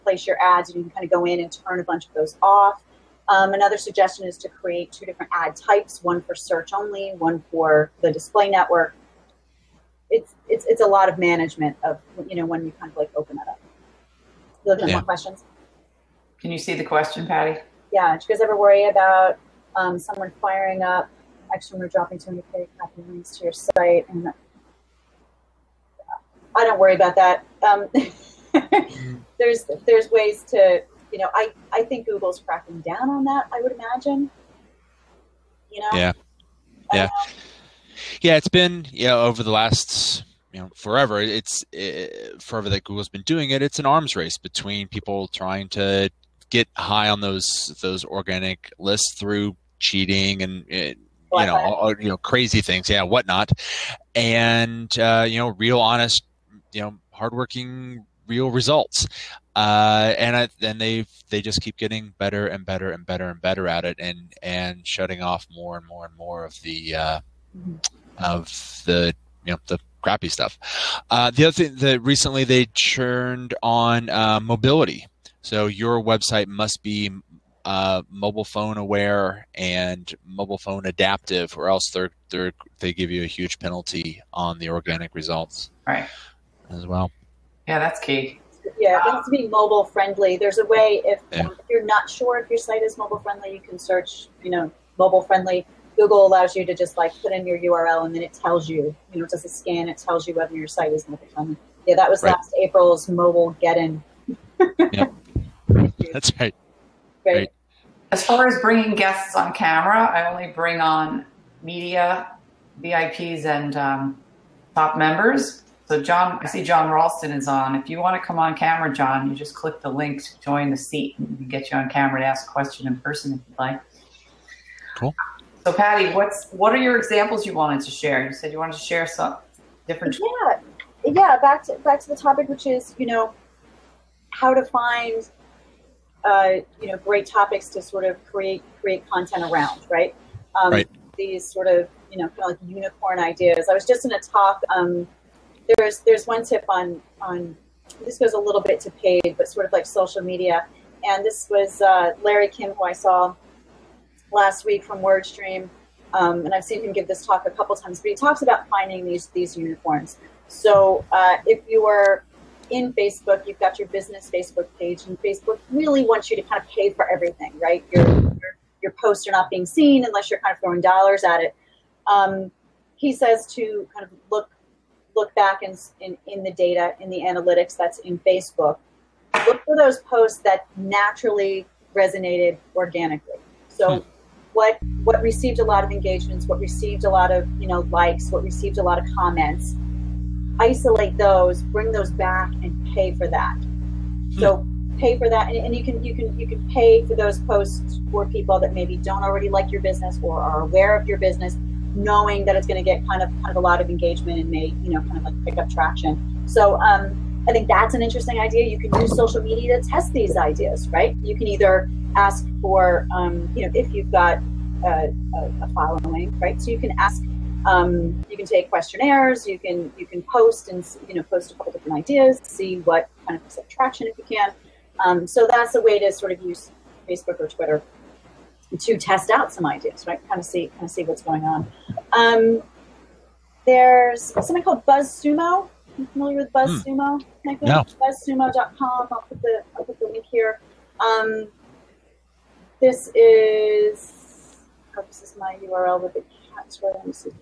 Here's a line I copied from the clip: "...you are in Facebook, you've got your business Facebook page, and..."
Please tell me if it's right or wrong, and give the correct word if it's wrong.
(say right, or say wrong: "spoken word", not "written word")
right.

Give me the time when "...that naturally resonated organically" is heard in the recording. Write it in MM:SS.
03:00.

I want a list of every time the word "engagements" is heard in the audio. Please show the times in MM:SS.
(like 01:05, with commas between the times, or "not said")
03:05, 03:23.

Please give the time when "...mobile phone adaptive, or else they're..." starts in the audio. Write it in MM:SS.
01:20.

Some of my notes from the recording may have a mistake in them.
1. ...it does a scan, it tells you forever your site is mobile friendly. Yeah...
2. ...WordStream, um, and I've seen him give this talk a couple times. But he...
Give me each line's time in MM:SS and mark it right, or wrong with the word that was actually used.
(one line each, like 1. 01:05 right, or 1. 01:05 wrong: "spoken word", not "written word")
1. 01:39 wrong: "whether", not "forever"
2. 02:35 right.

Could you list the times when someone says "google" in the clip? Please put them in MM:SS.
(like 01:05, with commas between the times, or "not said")
00:32, 00:42, 01:35.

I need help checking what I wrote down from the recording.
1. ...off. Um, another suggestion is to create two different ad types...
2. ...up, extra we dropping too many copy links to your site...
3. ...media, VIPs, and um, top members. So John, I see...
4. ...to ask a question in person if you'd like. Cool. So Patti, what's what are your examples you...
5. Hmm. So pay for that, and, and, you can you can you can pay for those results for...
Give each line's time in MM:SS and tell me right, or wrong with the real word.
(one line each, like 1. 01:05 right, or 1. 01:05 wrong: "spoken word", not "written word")
1. 00:02 right
2. 00:20 right
3. 01:51 right
4. 02:02 right
5. 03:14 wrong: "posts", not "results".